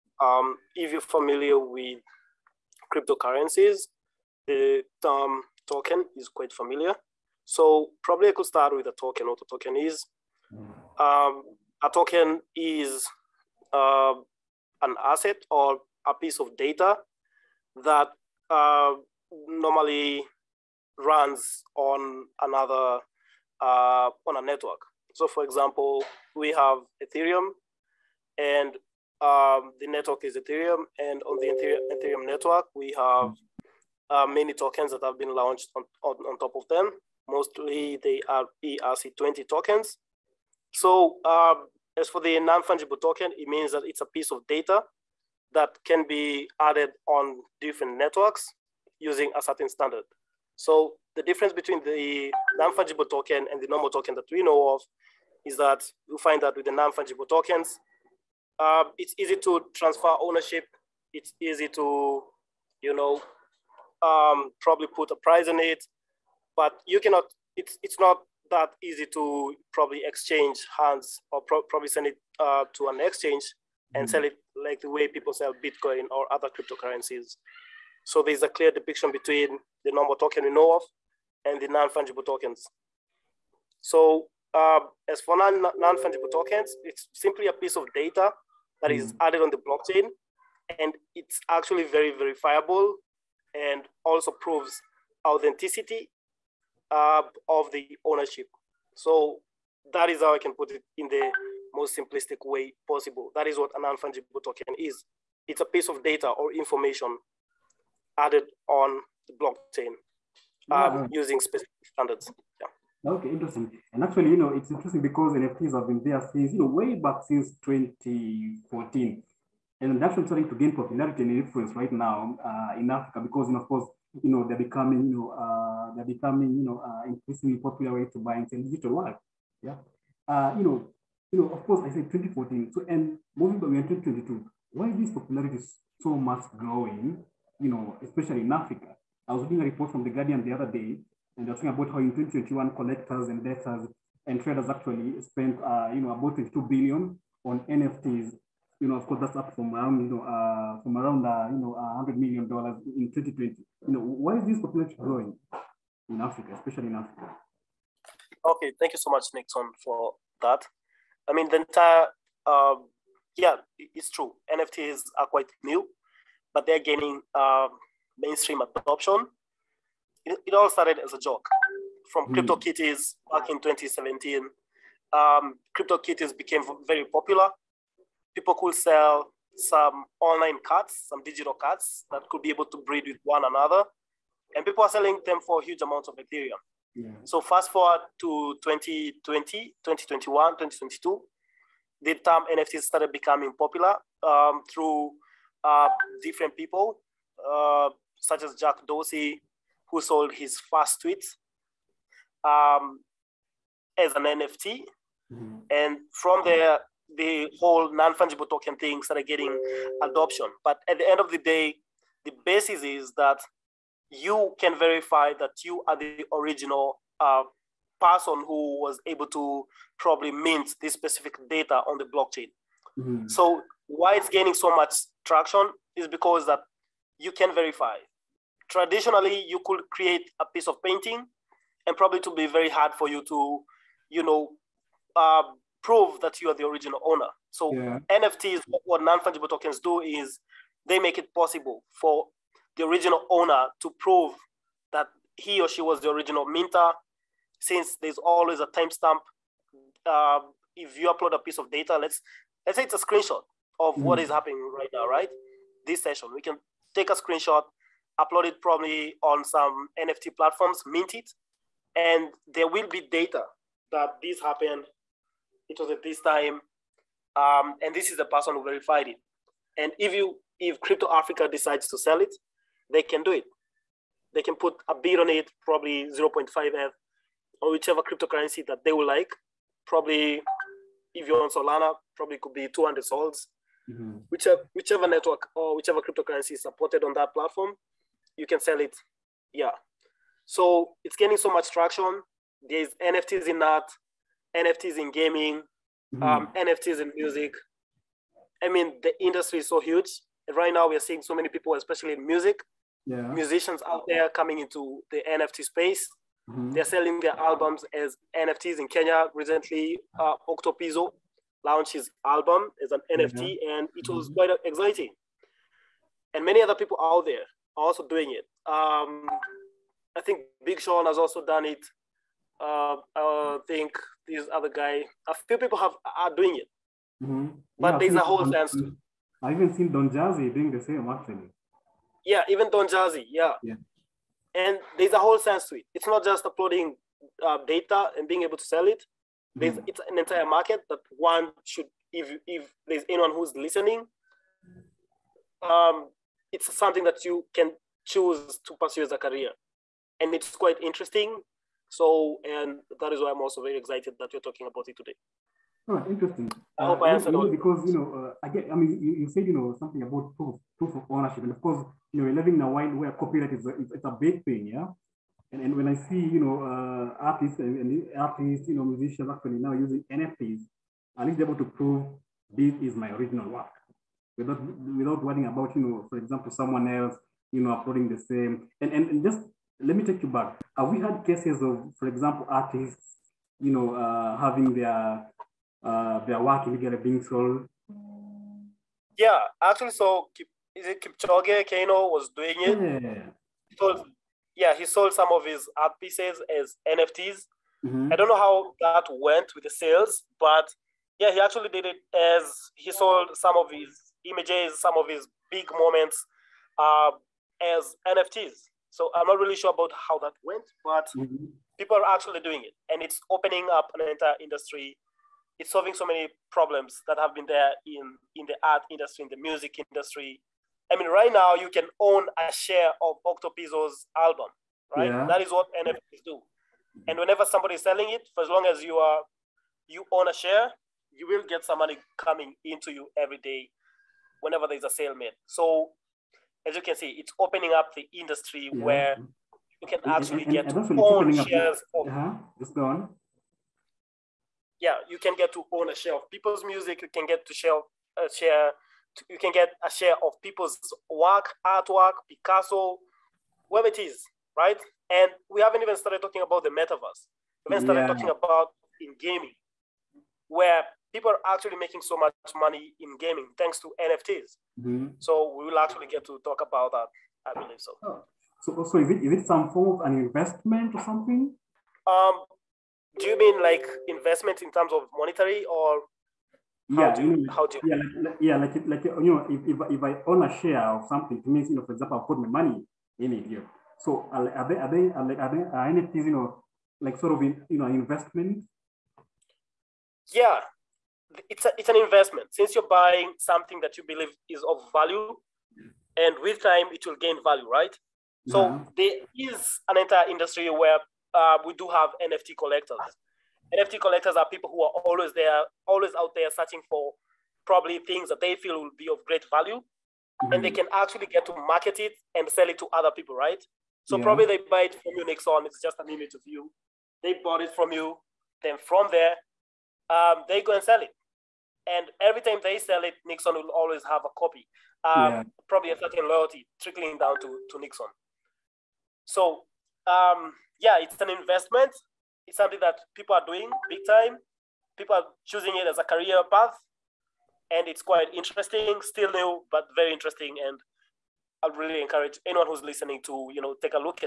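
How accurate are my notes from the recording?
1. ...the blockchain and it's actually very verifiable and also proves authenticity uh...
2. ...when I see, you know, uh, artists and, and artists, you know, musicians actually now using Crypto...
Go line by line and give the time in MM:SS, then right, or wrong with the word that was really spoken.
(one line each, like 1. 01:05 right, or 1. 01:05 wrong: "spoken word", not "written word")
1. 01:29 right
2. 06:05 wrong: "NFTs", not "Crypto".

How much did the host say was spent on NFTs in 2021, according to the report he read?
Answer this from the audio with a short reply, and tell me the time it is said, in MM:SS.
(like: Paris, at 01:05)
22 billion, at 02:26.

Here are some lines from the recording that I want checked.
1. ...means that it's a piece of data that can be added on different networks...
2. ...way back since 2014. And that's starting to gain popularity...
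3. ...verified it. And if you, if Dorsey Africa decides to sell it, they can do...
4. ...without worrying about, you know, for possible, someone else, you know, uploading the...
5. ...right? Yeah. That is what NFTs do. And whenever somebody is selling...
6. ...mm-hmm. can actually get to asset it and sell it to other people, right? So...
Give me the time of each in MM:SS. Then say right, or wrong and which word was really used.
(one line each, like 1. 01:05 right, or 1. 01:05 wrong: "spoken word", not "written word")
1. 00:43 right
2. 01:56 right
3. 04:28 wrong: "Crypto", not "Dorsey"
4. 06:14 wrong: "example", not "possible"
5. 07:04 right
6. 08:30 wrong: "market", not "asset".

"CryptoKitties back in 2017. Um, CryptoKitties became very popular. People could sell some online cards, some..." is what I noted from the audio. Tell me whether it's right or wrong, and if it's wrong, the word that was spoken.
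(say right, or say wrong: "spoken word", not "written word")
right.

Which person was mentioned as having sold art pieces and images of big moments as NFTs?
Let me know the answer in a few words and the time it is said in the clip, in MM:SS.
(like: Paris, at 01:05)
Kipchoge Kano, at 06:31.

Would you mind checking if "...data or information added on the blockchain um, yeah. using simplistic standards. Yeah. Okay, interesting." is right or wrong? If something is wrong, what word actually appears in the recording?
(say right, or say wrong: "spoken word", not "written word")
wrong: "specific", not "simplistic".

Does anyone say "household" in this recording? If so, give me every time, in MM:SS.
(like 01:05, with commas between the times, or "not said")
not said.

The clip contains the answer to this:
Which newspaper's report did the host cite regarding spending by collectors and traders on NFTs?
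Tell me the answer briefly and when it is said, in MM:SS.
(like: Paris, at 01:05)
The Guardian, at 02:20.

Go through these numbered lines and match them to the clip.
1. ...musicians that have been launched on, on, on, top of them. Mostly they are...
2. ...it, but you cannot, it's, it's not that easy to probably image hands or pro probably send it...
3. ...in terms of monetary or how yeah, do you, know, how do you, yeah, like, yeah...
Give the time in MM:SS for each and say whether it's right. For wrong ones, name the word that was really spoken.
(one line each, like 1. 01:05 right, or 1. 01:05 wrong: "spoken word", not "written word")
1. 00:34 wrong: "tokens", not "musicians"
2. 01:05 wrong: "exchange", not "image"
3. 07:54 right.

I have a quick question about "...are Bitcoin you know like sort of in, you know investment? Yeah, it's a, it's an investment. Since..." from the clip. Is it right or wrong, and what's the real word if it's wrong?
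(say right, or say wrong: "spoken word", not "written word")
wrong: "NFTs", not "Bitcoin".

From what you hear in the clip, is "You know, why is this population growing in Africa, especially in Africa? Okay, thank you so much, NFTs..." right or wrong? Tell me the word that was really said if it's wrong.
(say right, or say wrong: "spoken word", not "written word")
wrong: "Nixon", not "NFTs".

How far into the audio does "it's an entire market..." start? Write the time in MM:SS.
05:39.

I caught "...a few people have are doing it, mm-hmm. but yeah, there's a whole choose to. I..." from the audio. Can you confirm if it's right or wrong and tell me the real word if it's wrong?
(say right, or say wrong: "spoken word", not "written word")
wrong: "sense", not "choose".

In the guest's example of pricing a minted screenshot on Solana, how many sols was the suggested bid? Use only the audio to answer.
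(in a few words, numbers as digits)
200.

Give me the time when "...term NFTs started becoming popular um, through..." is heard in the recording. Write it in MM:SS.
03:12.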